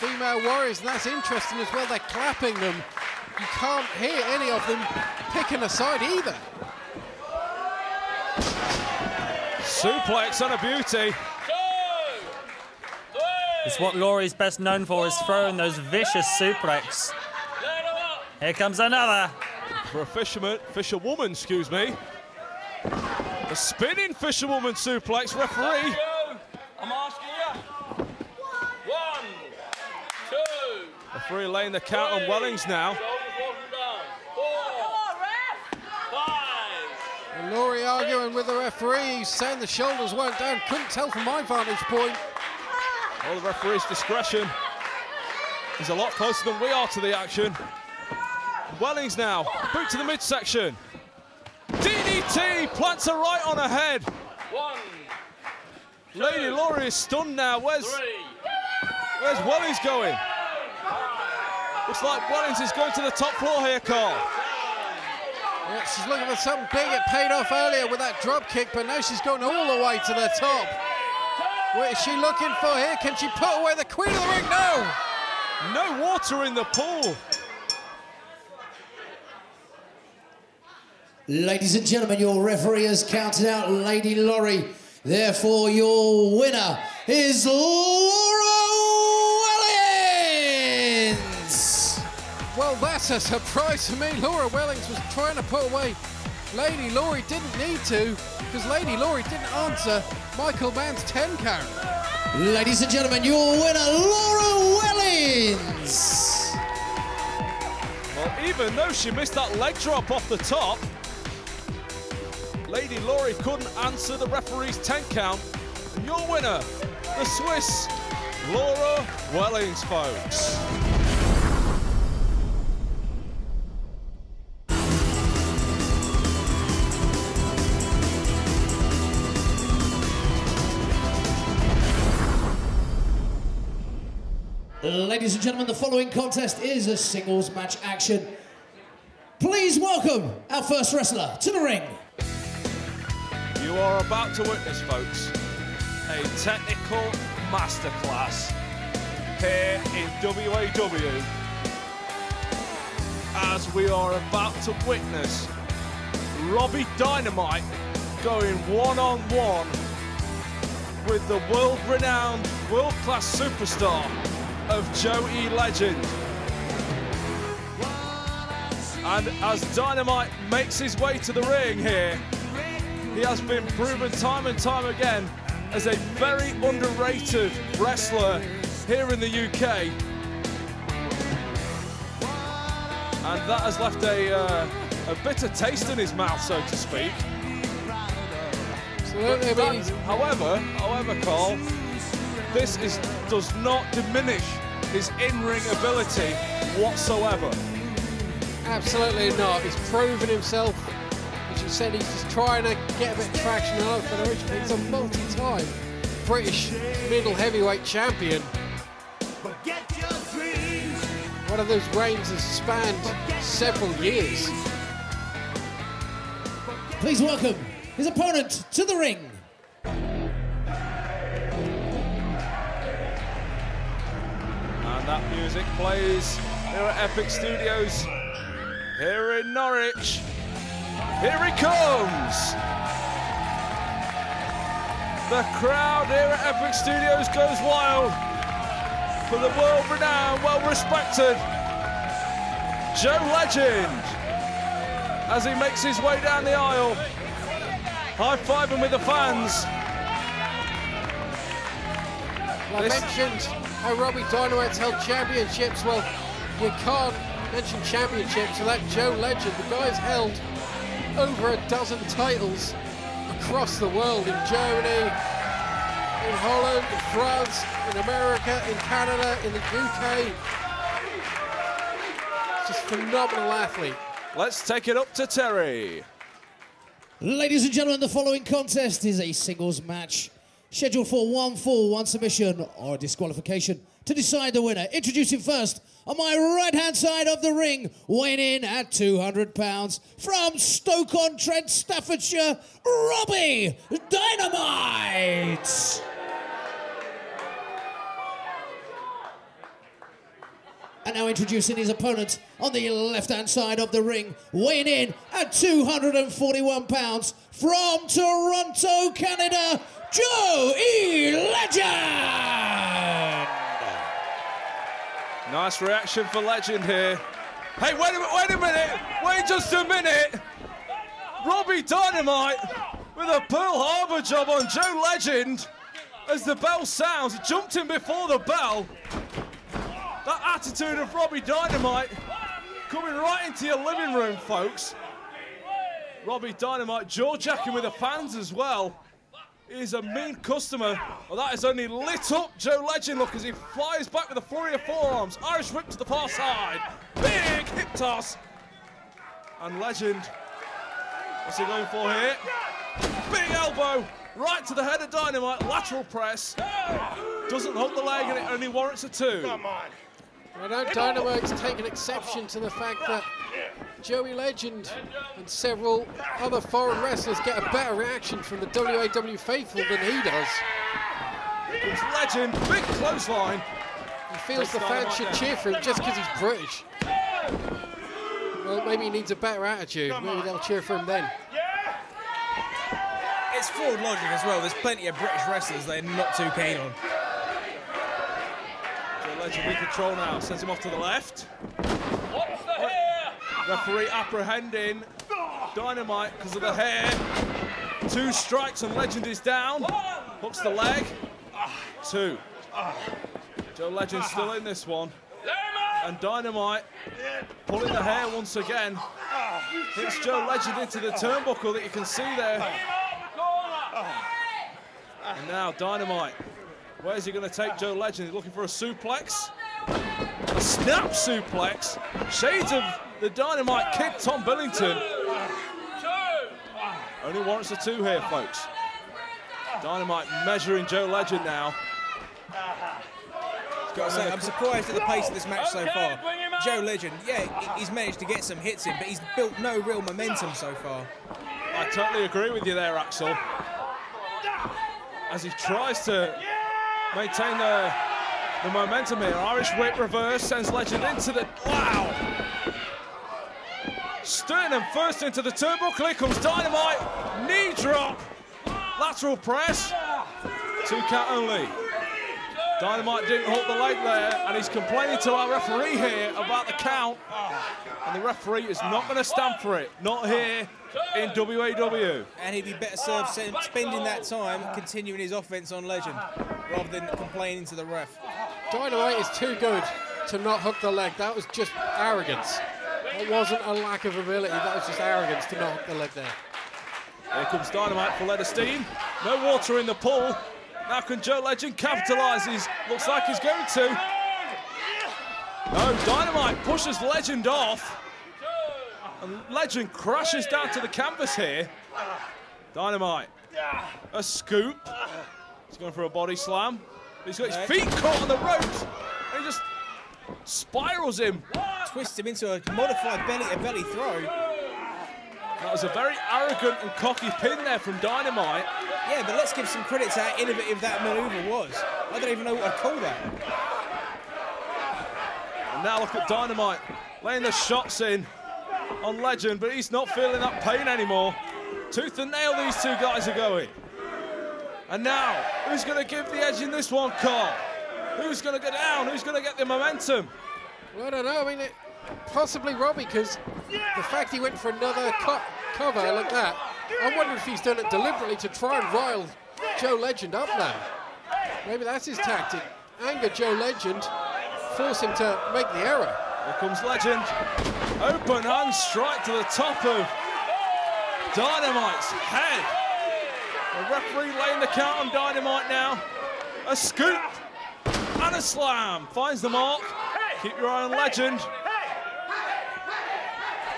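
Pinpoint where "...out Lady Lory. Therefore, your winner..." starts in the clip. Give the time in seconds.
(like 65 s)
83 s.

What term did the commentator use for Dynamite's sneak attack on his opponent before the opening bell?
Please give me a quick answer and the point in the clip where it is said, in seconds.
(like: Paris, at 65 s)
Pearl Harbor job, at 323 s.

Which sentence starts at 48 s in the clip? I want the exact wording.
Wellings now, boot to the midsection.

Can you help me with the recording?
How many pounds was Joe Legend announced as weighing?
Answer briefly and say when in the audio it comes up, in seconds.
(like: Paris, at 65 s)
241, at 305 s.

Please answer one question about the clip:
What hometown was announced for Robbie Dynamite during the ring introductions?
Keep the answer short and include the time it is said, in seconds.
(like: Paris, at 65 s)
Stoke-on-Trent, at 290 s.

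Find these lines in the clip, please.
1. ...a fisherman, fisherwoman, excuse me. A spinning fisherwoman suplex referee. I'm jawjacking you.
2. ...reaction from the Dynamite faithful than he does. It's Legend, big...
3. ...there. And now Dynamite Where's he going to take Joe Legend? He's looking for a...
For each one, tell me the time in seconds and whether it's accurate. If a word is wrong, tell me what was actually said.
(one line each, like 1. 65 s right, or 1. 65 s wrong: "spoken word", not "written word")
1. 20 s wrong: "asking", not "jawjacking"
2. 367 s wrong: "WAW", not "Dynamite"
3. 412 s right.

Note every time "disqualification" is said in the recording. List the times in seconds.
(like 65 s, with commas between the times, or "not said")
282 s.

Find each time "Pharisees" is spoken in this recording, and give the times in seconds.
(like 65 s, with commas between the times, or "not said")
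not said.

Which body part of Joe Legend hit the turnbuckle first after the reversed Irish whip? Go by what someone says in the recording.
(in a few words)
Sternum.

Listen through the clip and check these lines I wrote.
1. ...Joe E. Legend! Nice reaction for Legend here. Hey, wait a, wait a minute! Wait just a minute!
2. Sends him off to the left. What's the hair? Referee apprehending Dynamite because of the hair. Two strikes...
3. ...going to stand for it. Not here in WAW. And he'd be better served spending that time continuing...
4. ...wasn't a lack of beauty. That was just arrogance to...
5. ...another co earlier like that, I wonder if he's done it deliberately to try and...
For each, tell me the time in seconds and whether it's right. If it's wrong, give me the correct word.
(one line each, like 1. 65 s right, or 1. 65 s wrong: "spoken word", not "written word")
1. 310 s right
2. 390 s right
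3. 469 s right
4. 483 s wrong: "ability", not "beauty"
5. 544 s wrong: "cover", not "earlier".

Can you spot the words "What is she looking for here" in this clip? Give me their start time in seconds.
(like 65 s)
71 s.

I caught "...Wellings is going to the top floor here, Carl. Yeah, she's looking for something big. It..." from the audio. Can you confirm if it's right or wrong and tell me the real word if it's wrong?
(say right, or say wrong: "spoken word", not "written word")
right.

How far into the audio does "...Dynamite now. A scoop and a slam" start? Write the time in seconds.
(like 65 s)
565 s.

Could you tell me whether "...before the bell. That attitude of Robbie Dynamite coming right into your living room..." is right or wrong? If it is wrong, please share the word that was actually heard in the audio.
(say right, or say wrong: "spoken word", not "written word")
right.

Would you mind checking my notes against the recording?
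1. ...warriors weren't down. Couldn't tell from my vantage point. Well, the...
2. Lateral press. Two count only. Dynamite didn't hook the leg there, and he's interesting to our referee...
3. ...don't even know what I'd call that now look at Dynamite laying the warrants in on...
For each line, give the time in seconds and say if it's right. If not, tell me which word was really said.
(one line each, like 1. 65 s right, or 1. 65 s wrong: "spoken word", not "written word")
1. 39 s wrong: "shoulders", not "warriors"
2. 459 s wrong: "complaining", not "interesting"
3. 522 s wrong: "shots", not "warrants".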